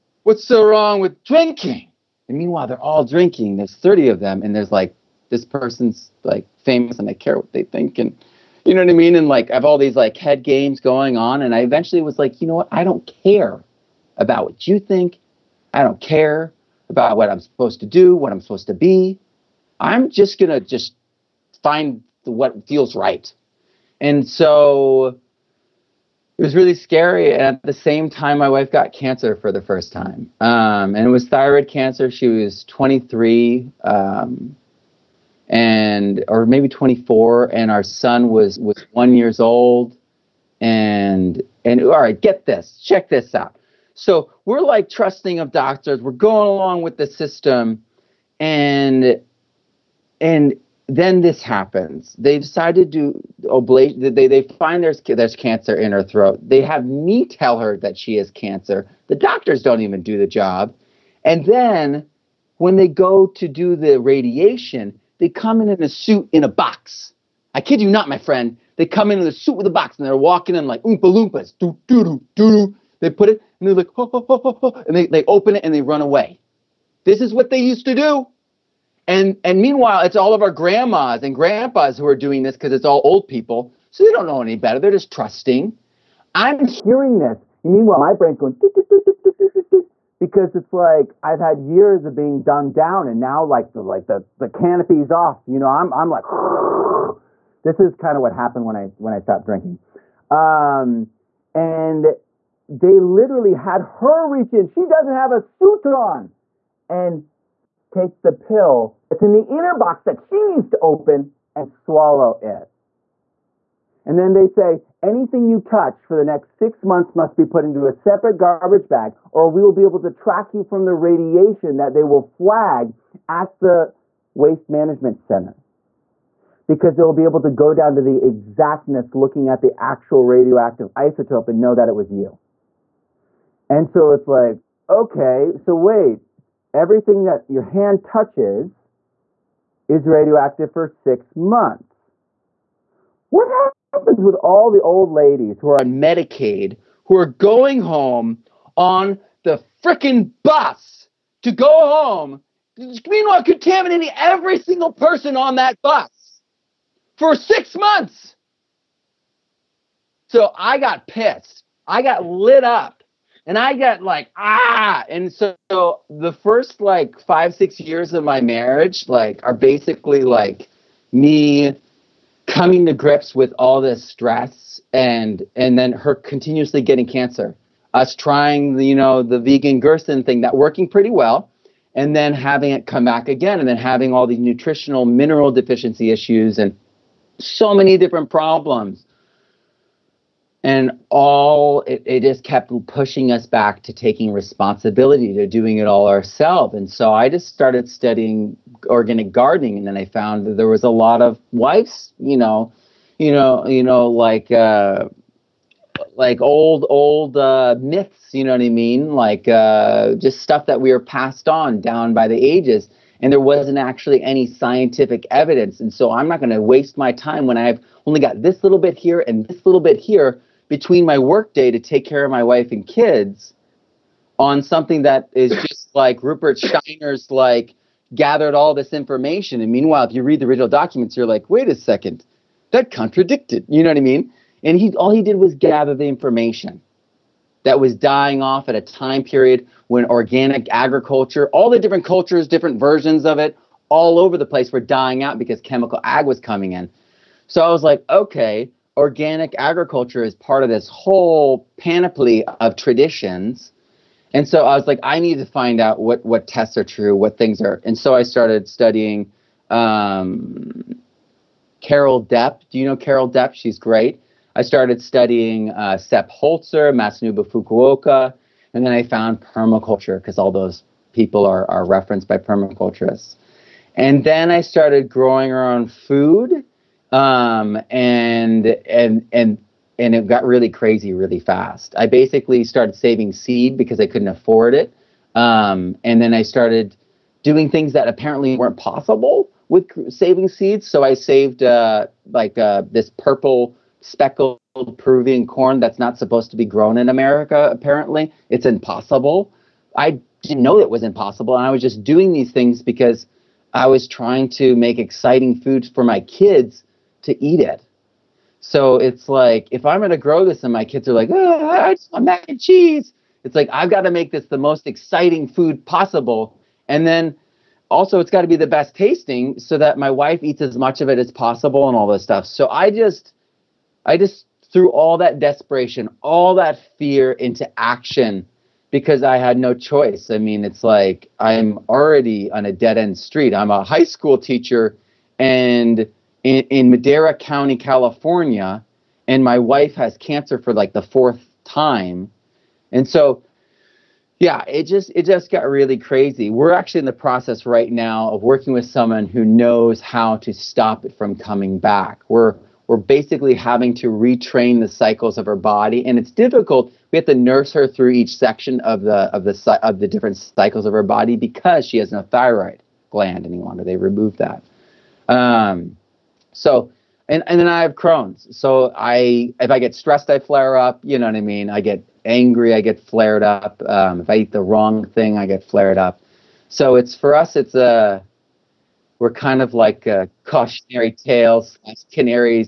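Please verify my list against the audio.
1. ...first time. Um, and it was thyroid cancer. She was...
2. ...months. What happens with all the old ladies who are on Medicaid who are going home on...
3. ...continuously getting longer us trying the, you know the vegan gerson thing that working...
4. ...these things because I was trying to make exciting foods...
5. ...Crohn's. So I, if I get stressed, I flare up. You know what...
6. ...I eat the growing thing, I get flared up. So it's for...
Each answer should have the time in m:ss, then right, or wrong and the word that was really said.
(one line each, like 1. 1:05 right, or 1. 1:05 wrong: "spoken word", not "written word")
1. 0:29 right
2. 2:21 right
3. 2:56 wrong: "cancer", not "longer"
4. 5:02 right
5. 6:07 right
6. 6:14 wrong: "wrong", not "growing".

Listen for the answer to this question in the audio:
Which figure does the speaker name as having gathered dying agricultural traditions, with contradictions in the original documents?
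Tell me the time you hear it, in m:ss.
3:46.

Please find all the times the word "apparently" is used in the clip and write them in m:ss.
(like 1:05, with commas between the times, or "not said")
4:48, 4:57.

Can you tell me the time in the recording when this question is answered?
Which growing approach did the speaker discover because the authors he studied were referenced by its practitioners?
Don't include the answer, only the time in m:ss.
4:29.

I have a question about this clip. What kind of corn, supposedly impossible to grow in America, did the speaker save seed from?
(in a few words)
purple speckled Peruvian corn.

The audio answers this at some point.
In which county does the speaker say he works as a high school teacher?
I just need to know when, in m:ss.
5:36.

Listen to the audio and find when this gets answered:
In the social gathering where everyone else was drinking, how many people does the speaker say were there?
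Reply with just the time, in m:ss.
0:03.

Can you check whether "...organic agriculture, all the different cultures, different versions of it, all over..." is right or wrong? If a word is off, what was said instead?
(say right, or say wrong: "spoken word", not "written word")
right.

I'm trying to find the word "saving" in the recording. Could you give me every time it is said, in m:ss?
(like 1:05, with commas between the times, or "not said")
4:42, 4:50.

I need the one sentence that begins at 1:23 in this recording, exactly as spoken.
So they don't know any better.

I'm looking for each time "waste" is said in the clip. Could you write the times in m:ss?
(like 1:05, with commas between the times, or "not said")
2:04, 3:36.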